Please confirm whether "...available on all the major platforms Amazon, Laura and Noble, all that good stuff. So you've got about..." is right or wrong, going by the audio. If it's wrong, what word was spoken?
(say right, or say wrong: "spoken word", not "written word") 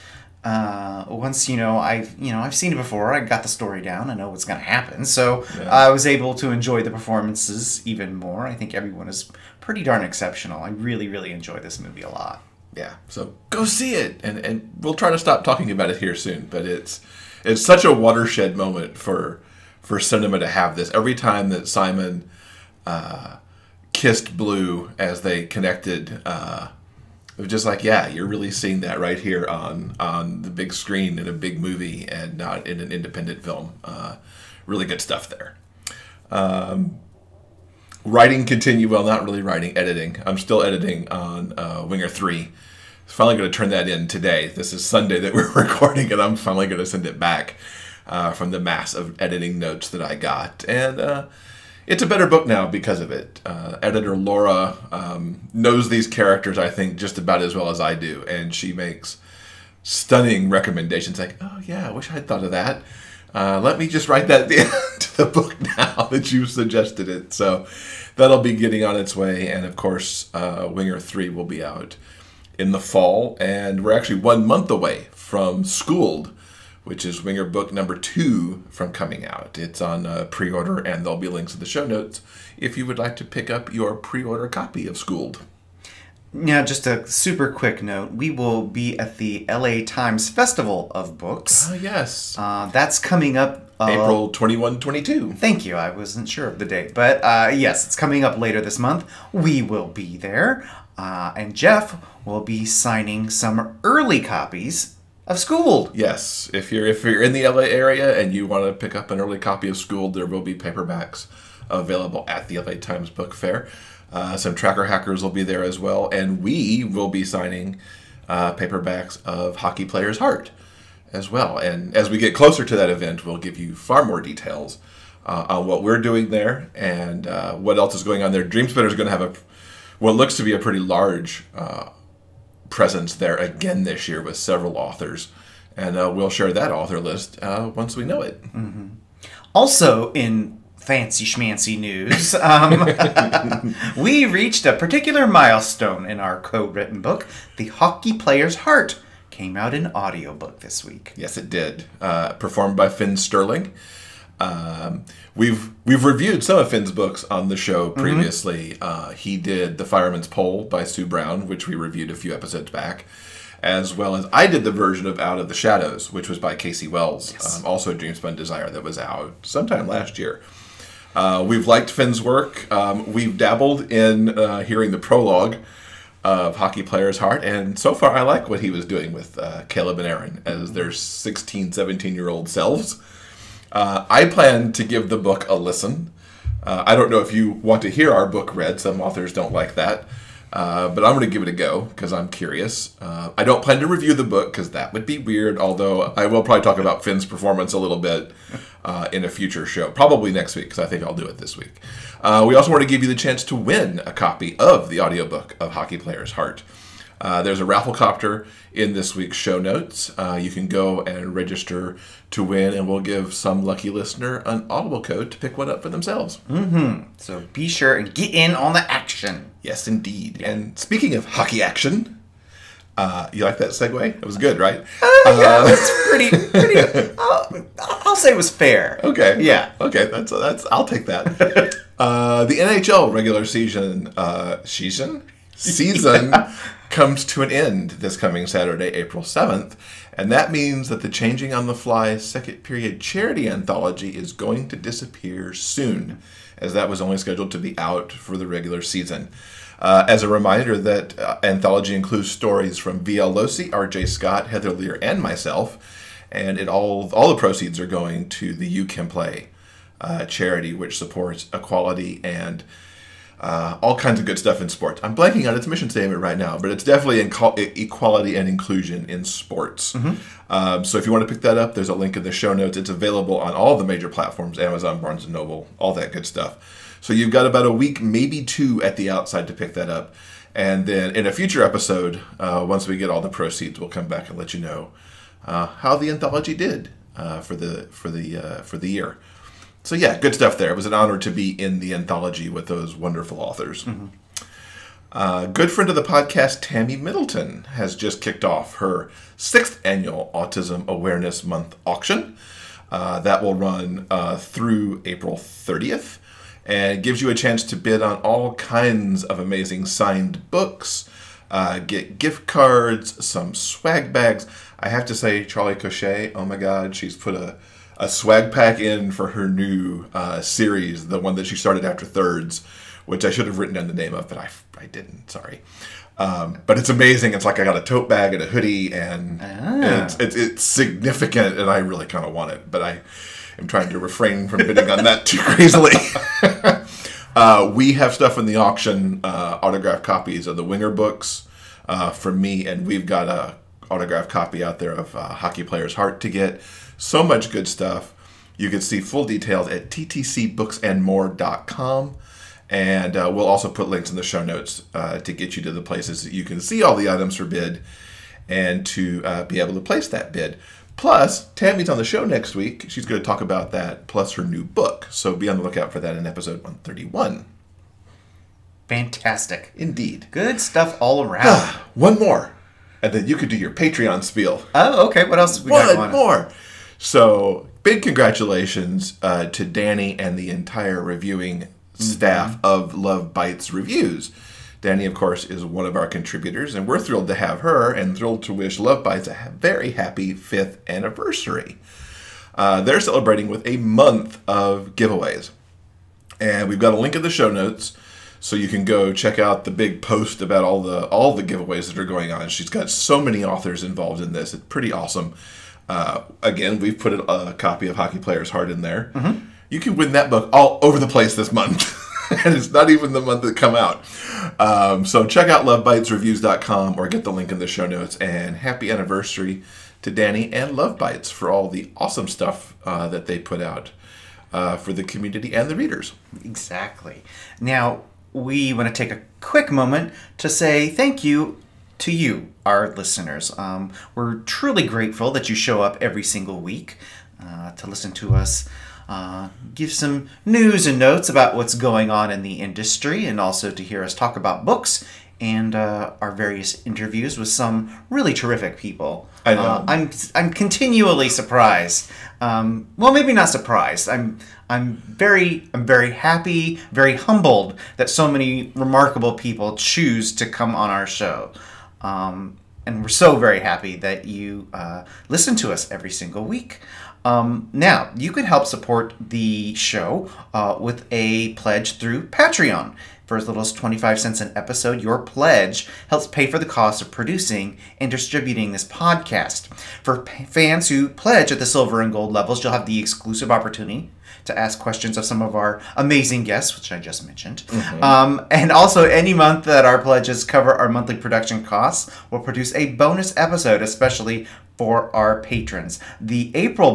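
wrong: "Barnes", not "Laura".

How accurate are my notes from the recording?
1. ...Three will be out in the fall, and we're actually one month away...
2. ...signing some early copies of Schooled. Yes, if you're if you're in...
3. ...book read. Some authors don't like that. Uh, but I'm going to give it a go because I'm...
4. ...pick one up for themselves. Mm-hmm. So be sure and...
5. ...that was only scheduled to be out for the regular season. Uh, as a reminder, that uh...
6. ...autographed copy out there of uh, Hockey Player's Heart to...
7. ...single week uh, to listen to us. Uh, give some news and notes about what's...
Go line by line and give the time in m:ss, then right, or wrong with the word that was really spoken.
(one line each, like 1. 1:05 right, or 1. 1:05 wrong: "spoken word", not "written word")
1. 1:10 right
2. 1:42 right
3. 3:08 right
4. 3:35 right
5. 4:06 right
6. 5:43 right
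7. 7:16 right.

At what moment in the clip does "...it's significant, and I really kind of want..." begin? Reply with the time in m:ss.
5:30.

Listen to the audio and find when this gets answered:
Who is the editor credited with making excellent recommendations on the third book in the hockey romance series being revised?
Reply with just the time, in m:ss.
0:54.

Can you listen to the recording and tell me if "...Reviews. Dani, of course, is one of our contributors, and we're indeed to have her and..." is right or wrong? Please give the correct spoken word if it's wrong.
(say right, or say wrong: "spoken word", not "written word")
wrong: "thrilled", not "indeed".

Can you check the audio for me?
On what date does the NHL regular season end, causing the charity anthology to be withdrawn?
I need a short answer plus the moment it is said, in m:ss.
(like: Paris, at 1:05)
April 7, at 3:58.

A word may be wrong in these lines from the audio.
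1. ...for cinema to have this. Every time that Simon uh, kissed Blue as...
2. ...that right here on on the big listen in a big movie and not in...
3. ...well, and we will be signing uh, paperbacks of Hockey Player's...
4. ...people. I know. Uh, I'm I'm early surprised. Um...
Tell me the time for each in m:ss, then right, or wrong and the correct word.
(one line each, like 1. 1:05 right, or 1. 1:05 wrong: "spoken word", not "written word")
1. 0:19 right
2. 0:28 wrong: "screen", not "listen"
3. 1:55 right
4. 7:28 wrong: "continually", not "early".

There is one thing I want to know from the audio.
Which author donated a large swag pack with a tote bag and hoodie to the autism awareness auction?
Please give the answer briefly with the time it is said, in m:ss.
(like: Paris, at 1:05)
Charlie Cochet, at 5:15.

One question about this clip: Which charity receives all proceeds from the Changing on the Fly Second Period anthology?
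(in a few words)
You Can Play.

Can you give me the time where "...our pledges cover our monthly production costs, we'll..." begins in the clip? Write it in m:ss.
8:09.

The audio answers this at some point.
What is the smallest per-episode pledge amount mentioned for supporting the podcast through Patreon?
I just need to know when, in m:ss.
7:53.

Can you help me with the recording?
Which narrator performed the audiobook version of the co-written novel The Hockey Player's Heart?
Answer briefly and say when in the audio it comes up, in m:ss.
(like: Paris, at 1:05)
Finn Sterling, at 2:32.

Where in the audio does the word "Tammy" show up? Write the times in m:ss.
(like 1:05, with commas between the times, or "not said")
4:56, 6:01.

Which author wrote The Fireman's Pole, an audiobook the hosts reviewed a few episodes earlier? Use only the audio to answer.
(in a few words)
Sue Brown.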